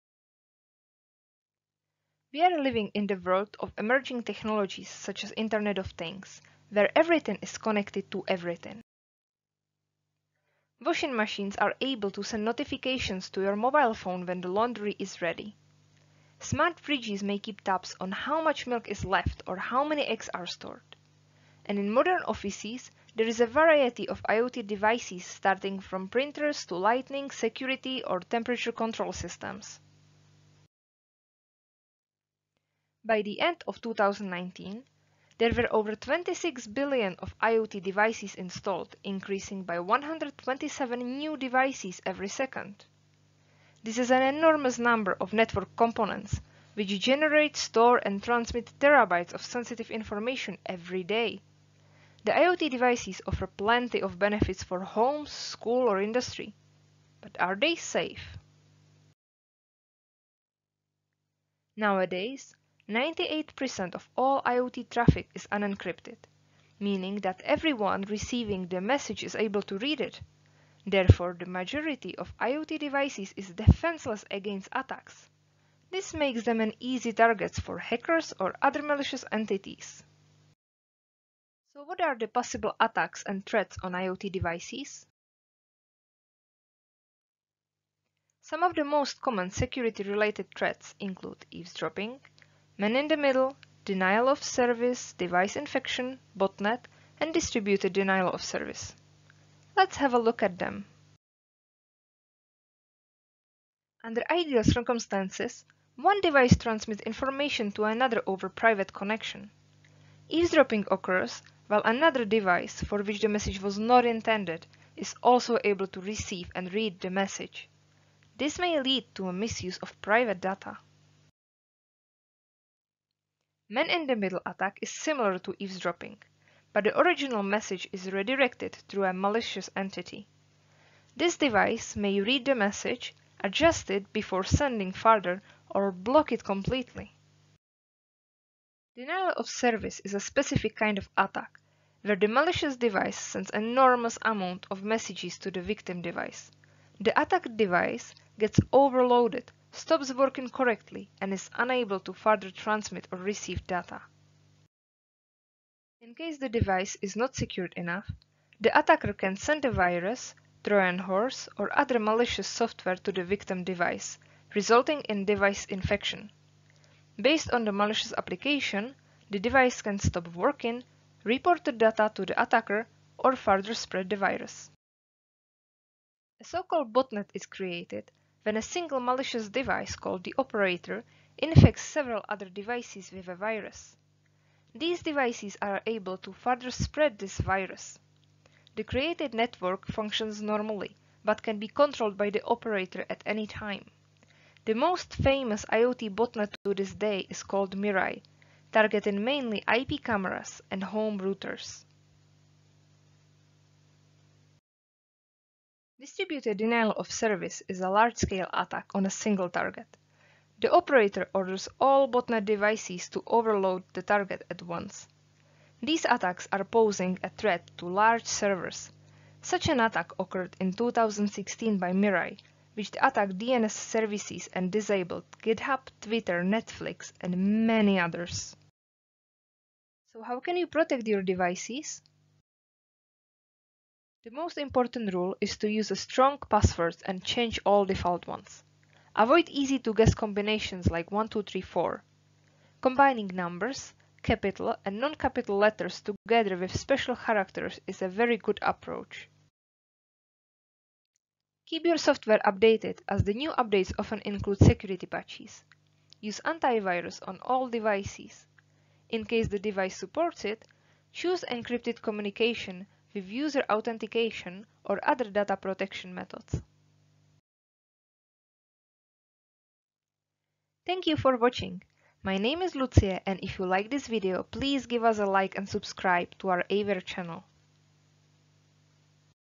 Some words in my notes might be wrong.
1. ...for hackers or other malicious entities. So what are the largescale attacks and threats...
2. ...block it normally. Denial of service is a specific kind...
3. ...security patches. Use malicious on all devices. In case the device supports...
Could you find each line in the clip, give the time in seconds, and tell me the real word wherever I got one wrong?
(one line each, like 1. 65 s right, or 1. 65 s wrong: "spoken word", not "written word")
1. 77 s wrong: "possible", not "largescale"
2. 135 s wrong: "completely", not "normally"
3. 254 s wrong: "antivirus", not "malicious".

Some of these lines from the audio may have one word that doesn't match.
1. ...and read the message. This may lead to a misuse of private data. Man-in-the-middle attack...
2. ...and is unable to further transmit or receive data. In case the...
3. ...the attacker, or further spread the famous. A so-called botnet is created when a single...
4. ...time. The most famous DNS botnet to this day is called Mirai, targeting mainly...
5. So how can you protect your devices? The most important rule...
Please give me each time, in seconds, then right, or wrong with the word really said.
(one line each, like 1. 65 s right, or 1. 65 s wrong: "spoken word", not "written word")
1. 116 s right
2. 151 s right
3. 172 s wrong: "virus", not "famous"
4. 193 s wrong: "IoT", not "DNS"
5. 230 s right.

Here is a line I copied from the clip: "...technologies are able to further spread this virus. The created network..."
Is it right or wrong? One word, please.
wrong.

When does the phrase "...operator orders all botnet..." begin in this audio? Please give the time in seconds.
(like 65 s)
210 s.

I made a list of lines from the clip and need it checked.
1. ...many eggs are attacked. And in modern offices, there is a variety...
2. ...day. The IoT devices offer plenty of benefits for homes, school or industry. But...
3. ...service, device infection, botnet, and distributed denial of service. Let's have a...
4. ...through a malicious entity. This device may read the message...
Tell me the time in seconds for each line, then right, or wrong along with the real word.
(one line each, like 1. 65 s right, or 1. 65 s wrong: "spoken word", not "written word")
1. 19 s wrong: "stored", not "attacked"
2. 51 s right
3. 94 s right
4. 128 s right.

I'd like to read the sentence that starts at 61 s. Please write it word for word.
Nowadays, 98% of all IoT traffic is unencrypted, meaning that everyone receiving the message is able to read it.